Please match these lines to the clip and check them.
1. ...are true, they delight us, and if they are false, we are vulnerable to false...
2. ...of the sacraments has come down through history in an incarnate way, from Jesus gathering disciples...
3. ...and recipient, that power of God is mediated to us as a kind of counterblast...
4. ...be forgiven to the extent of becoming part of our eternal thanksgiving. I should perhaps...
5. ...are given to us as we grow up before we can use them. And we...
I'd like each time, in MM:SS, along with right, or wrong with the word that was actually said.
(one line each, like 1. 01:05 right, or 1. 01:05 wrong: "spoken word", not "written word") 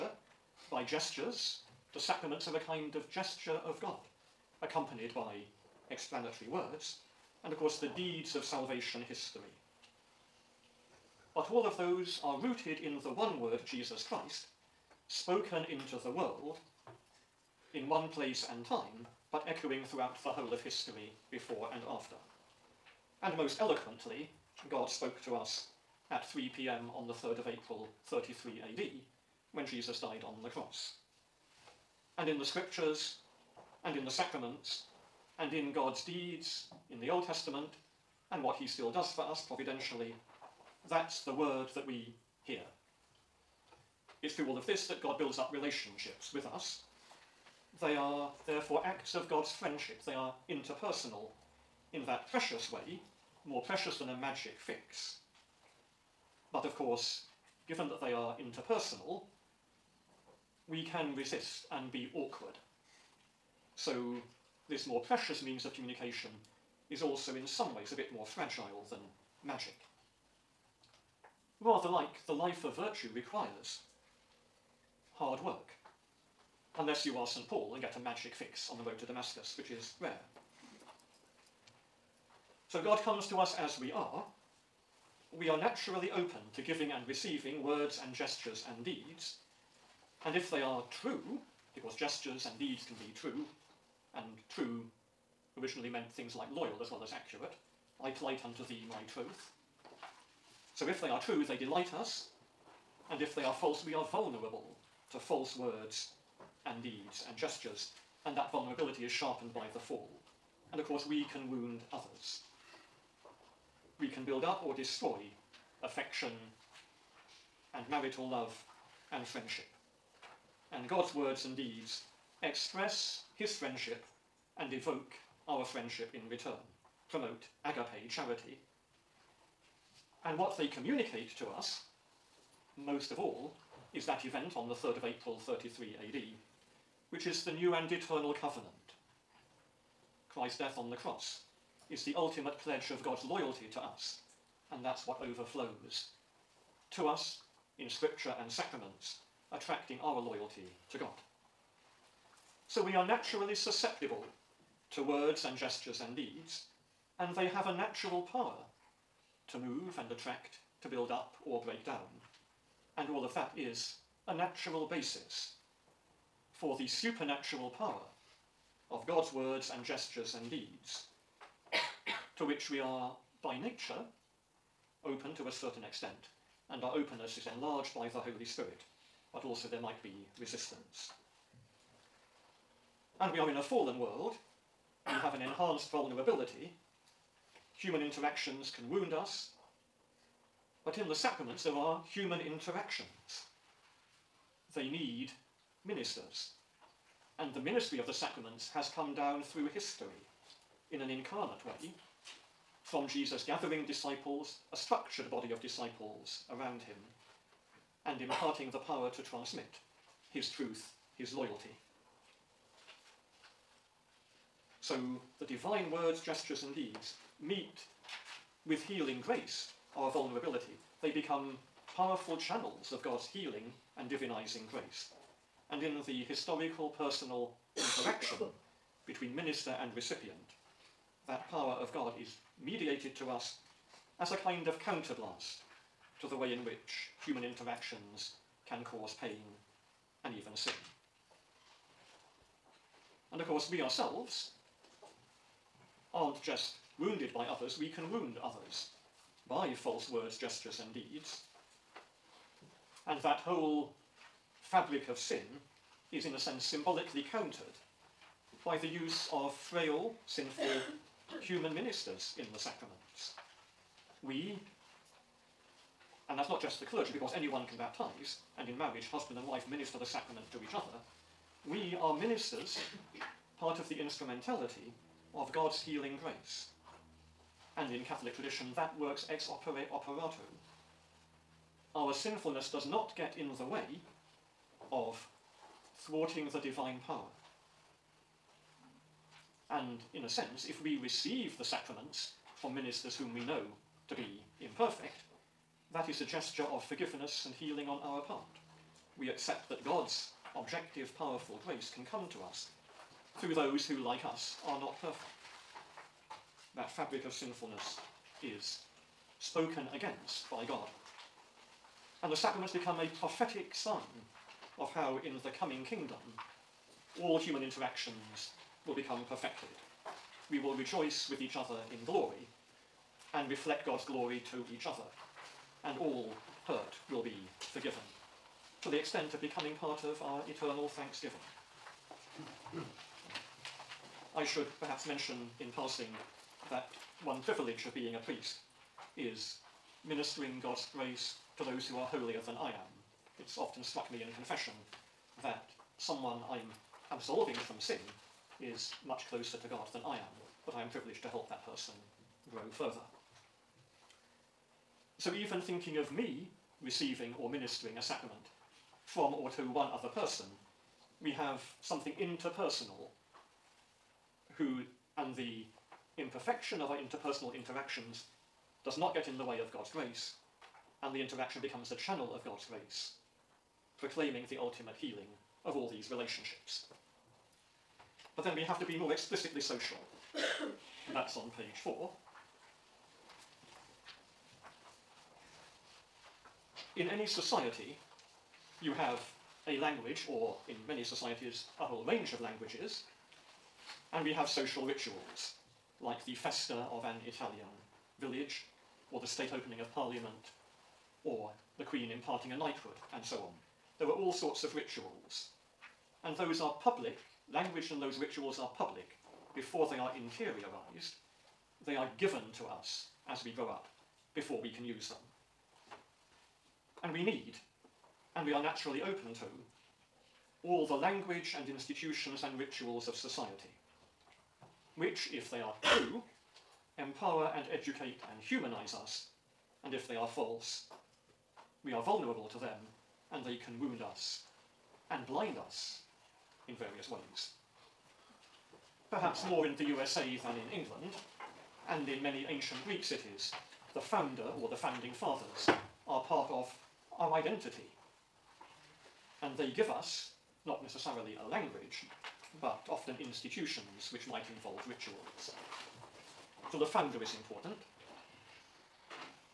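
1. 01:41 right
2. 03:17 right
3. 03:49 right
4. 05:27 right
5. 06:51 right.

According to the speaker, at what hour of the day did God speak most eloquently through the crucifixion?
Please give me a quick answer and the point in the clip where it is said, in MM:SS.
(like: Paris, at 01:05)
3 pm, at 00:26.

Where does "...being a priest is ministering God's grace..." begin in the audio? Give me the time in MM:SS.
05:37.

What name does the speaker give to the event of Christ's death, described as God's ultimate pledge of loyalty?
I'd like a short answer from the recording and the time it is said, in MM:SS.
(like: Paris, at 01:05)
the new and eternal covenant, at 02:17.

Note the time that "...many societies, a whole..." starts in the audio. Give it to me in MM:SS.
06:30.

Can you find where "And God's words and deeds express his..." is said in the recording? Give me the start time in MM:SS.
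02:00.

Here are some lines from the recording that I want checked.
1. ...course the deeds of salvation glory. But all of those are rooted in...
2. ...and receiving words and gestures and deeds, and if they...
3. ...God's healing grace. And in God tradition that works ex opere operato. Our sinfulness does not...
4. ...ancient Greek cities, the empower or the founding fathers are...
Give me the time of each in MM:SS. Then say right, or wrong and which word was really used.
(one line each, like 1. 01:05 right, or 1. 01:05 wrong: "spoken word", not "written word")
1. 00:07 wrong: "history", not "glory"
2. 01:26 right
3. 04:35 wrong: "Catholic", not "God"
4. 07:22 wrong: "founder", not "empower".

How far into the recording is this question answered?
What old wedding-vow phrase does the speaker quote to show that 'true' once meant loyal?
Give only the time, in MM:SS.
01:38.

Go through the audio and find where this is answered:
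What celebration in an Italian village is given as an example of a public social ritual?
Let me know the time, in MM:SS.
06:36.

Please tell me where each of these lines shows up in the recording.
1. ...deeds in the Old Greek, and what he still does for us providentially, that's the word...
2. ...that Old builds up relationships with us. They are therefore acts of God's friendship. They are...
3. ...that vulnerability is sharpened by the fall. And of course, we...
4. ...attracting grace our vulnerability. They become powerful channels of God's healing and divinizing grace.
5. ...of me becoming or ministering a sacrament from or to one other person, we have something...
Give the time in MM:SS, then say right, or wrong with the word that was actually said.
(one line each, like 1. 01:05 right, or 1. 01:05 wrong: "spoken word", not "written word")
1. 00:36 wrong: "Testament", not "Greek"
2. 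00:44 wrong: "God", not "Old"
3. 01:48 right
4. 03:38 wrong: "healing", not "attracting"
5. 05:55 wrong: "receiving", not "becoming".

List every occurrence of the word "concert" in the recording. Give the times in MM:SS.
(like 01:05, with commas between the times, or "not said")
not said.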